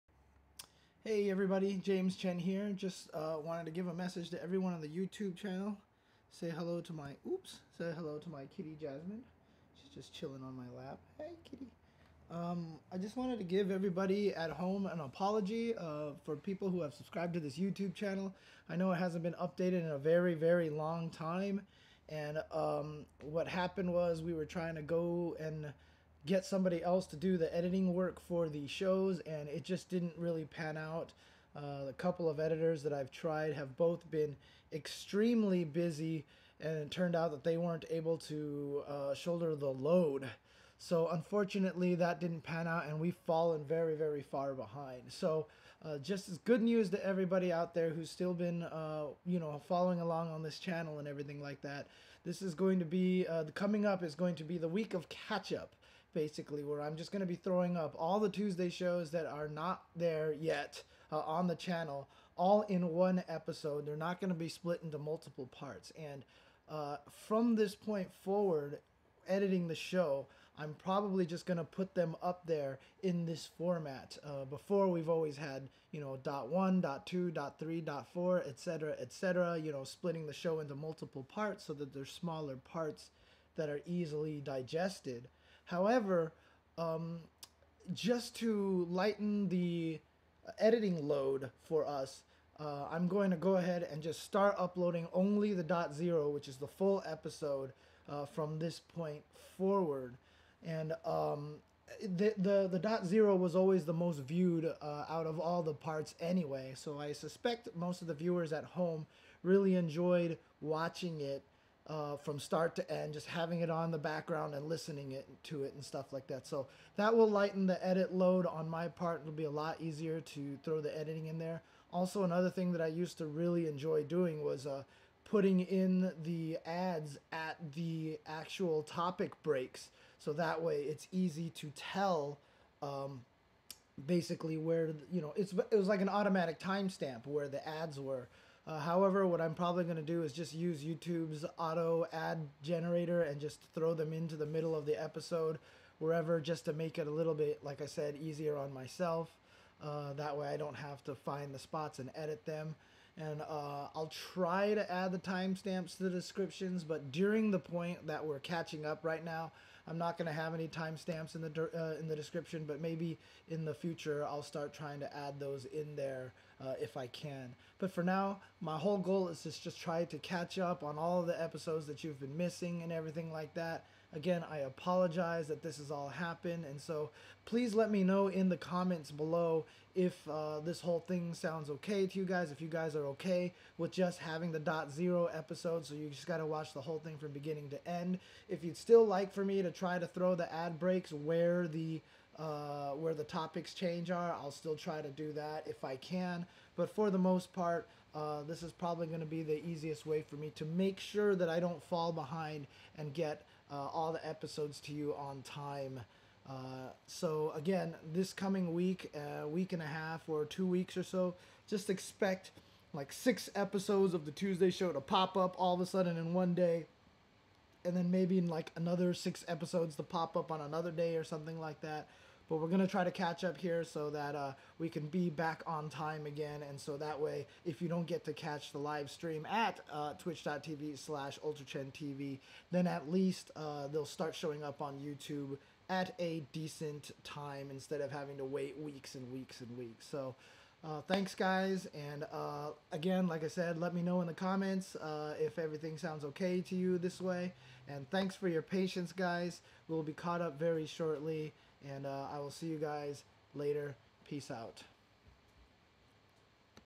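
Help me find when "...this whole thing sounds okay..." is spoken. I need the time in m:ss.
3:00.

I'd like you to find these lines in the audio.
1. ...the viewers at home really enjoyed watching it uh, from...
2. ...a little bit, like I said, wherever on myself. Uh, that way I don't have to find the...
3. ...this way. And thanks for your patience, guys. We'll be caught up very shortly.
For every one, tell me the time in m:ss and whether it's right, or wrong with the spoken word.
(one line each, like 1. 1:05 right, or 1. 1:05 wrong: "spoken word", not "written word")
1. 1:48 right
2. 2:27 wrong: "easier", not "wherever"
3. 4:06 right.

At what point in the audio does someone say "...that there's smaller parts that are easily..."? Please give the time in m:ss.
1:21.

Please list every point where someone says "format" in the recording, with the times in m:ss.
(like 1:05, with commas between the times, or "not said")
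1:13.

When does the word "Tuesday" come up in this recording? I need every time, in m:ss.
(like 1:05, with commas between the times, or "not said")
0:58, 3:34.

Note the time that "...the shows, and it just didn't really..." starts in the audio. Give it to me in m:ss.
0:28.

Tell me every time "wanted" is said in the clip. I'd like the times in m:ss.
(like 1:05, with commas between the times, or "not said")
0:03, 0:13.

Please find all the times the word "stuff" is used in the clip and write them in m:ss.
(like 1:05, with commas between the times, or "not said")
1:55.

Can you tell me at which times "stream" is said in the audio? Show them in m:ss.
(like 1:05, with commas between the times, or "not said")
3:49.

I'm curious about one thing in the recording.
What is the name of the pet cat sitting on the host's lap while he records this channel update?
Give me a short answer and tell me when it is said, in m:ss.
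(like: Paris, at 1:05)
Jasmine, at 0:08.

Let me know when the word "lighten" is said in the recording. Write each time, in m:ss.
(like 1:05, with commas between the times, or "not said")
1:28, 1:57.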